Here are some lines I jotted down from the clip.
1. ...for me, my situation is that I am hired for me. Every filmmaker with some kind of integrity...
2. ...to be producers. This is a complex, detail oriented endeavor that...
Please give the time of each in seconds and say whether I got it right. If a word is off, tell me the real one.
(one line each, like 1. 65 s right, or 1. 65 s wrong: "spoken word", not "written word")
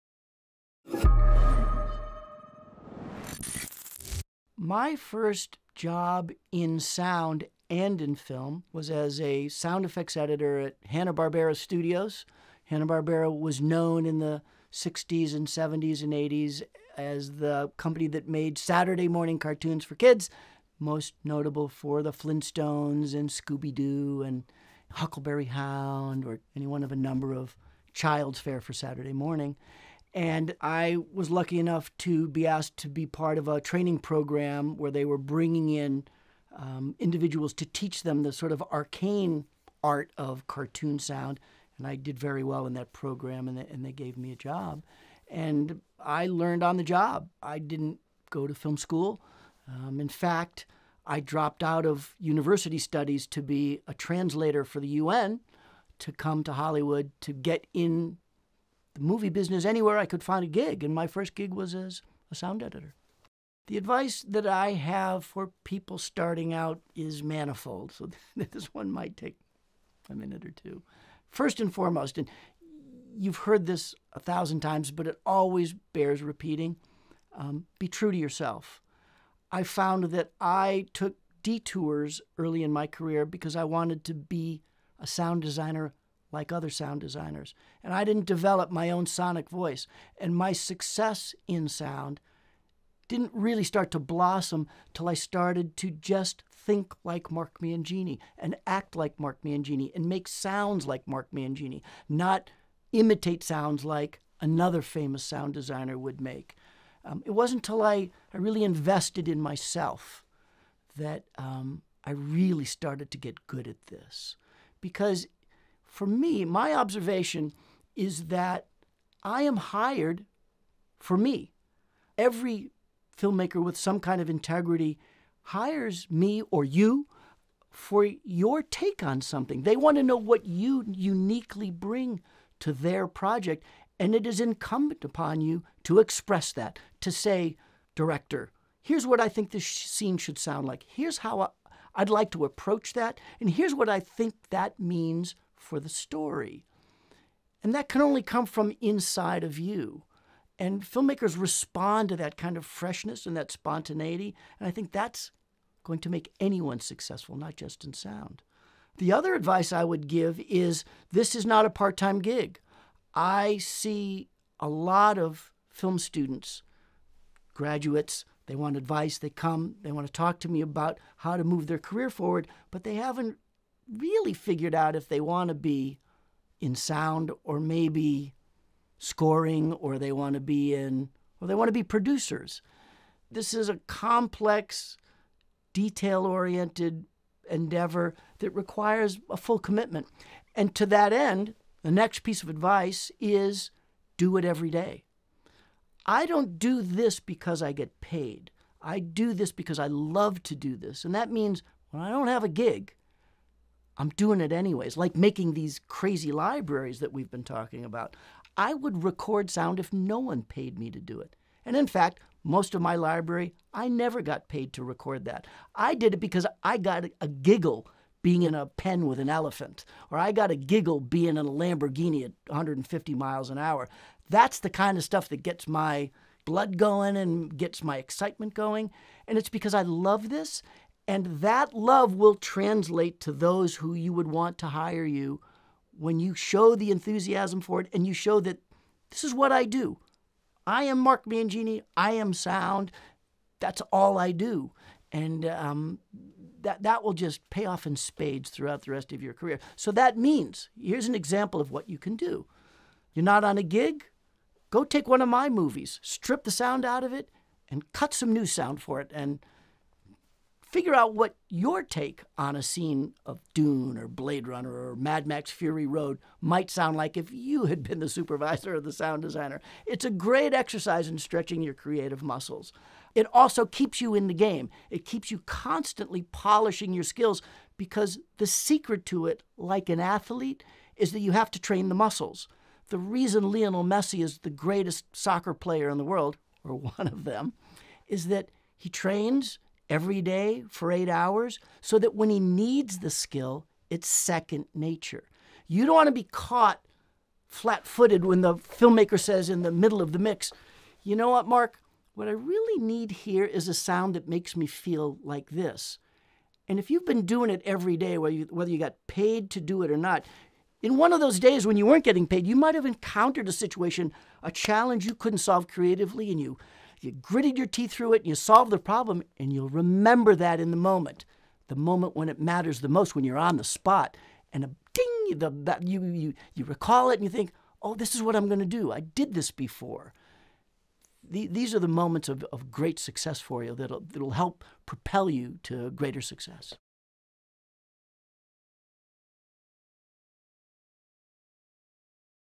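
1. 115 s wrong: "observation", not "situation"
2. 181 s right.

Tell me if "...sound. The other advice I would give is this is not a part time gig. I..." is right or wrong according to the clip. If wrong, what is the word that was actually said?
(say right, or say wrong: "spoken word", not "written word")
right.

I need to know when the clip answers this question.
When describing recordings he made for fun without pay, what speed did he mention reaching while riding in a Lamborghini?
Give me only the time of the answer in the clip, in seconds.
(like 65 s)
222 s.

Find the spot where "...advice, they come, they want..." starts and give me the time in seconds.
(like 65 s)
168 s.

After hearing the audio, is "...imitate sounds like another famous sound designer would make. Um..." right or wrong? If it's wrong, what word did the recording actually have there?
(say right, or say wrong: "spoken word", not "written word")
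right.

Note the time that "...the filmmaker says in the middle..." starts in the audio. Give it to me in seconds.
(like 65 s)
298 s.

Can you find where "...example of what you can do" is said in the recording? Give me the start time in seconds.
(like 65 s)
251 s.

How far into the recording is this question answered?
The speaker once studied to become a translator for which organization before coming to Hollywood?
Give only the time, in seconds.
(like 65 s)
54 s.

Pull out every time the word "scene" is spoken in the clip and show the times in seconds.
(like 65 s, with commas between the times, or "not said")
139 s, 262 s.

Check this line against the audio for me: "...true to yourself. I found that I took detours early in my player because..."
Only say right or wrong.
wrong.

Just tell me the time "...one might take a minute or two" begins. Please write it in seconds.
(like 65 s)
68 s.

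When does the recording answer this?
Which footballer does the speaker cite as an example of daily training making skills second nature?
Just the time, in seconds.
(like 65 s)
283 s.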